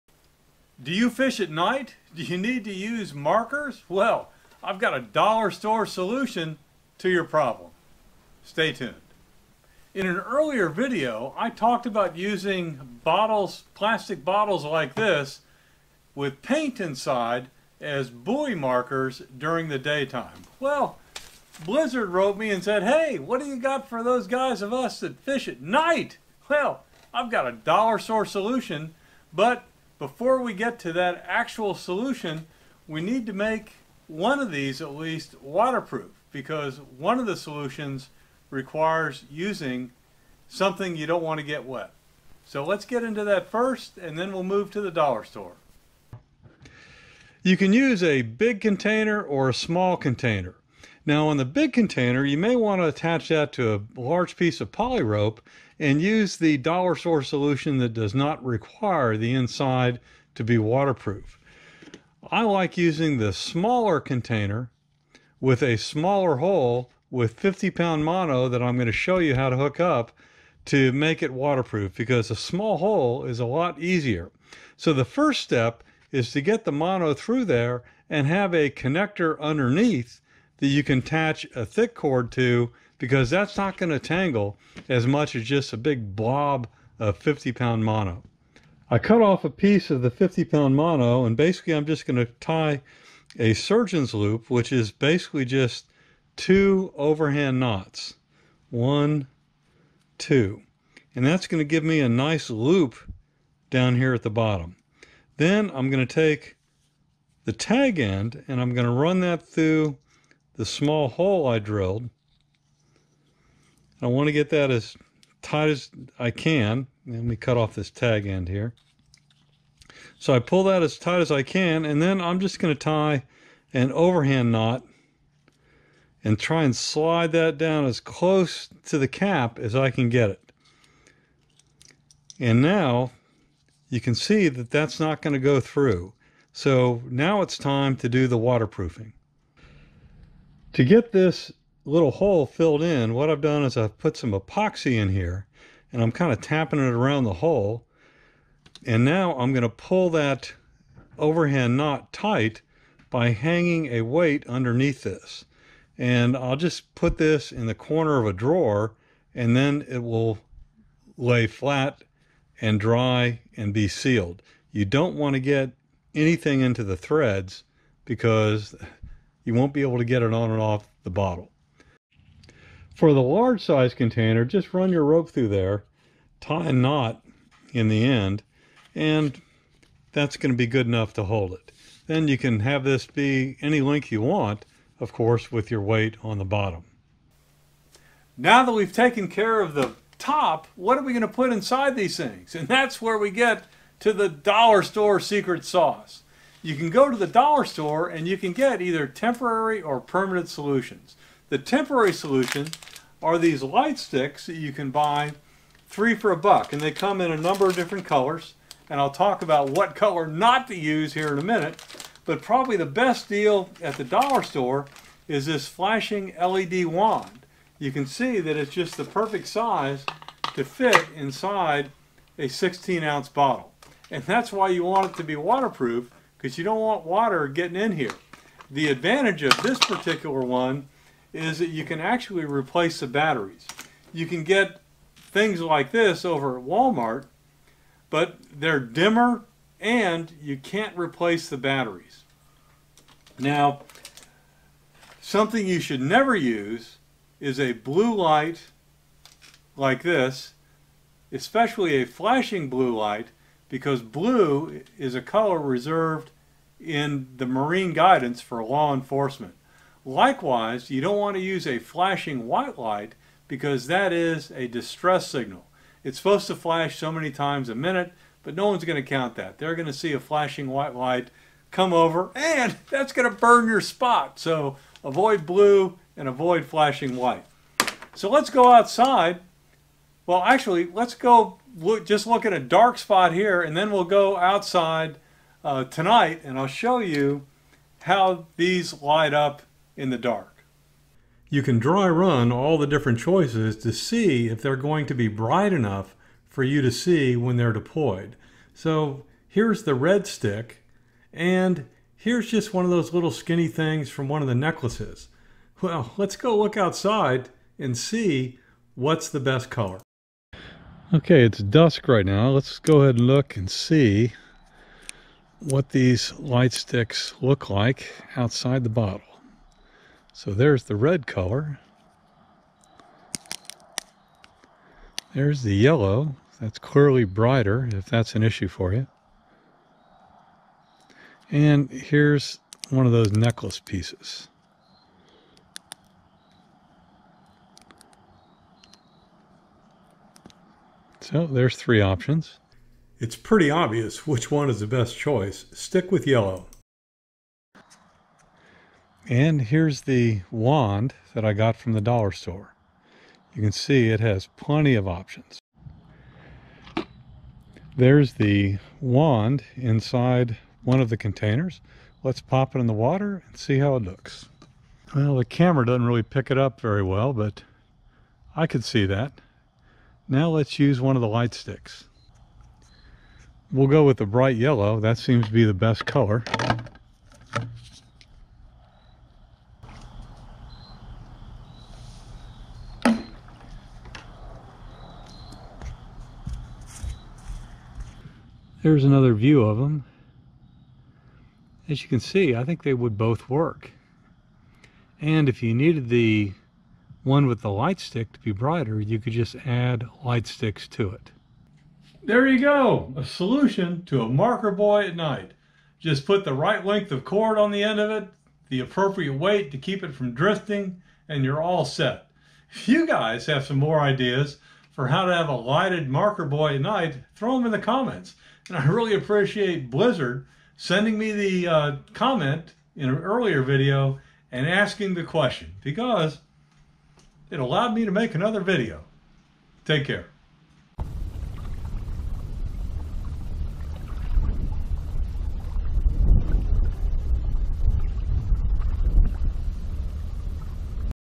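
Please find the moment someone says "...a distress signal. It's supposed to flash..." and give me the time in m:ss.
4:24.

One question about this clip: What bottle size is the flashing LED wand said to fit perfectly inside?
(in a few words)
16 ounce.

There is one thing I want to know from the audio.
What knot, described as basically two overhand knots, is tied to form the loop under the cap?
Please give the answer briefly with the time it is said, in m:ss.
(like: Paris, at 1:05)
Surgeon's loop, at 1:33.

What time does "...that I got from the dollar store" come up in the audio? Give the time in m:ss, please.
5:51.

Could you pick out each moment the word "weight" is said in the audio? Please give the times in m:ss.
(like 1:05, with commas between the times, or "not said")
2:34, 3:05, 6:49.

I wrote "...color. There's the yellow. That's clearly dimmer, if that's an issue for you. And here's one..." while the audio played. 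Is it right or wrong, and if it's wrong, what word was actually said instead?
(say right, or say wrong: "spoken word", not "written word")
wrong: "brighter", not "dimmer".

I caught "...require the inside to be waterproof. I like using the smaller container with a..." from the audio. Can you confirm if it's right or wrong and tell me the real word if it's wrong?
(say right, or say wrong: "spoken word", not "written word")
right.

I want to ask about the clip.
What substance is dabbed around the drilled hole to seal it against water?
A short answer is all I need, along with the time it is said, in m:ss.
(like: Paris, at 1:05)
Epoxy, at 2:24.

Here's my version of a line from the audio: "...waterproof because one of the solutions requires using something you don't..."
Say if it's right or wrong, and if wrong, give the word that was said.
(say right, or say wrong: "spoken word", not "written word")
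right.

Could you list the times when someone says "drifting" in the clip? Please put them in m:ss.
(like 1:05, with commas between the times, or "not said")
6:50.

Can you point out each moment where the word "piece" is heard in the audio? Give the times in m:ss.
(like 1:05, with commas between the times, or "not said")
0:54, 1:29, 5:33.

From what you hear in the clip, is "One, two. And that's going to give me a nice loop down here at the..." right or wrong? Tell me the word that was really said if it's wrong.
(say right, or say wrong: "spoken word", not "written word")
right.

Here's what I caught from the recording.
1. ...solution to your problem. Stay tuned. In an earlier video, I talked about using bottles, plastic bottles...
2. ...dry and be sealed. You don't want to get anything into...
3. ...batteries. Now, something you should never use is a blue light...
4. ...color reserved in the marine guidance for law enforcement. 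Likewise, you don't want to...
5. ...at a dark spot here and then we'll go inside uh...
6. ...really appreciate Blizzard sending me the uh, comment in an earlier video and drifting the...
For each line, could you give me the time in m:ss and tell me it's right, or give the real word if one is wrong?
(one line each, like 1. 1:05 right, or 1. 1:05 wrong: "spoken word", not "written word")
1. 0:05 right
2. 2:42 right
3. 4:01 right
4. 4:15 right
5. 4:42 wrong: "outside", not "inside"
6. 6:58 wrong: "asking", not "drifting".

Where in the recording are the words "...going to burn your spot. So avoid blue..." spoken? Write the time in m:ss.
4:33.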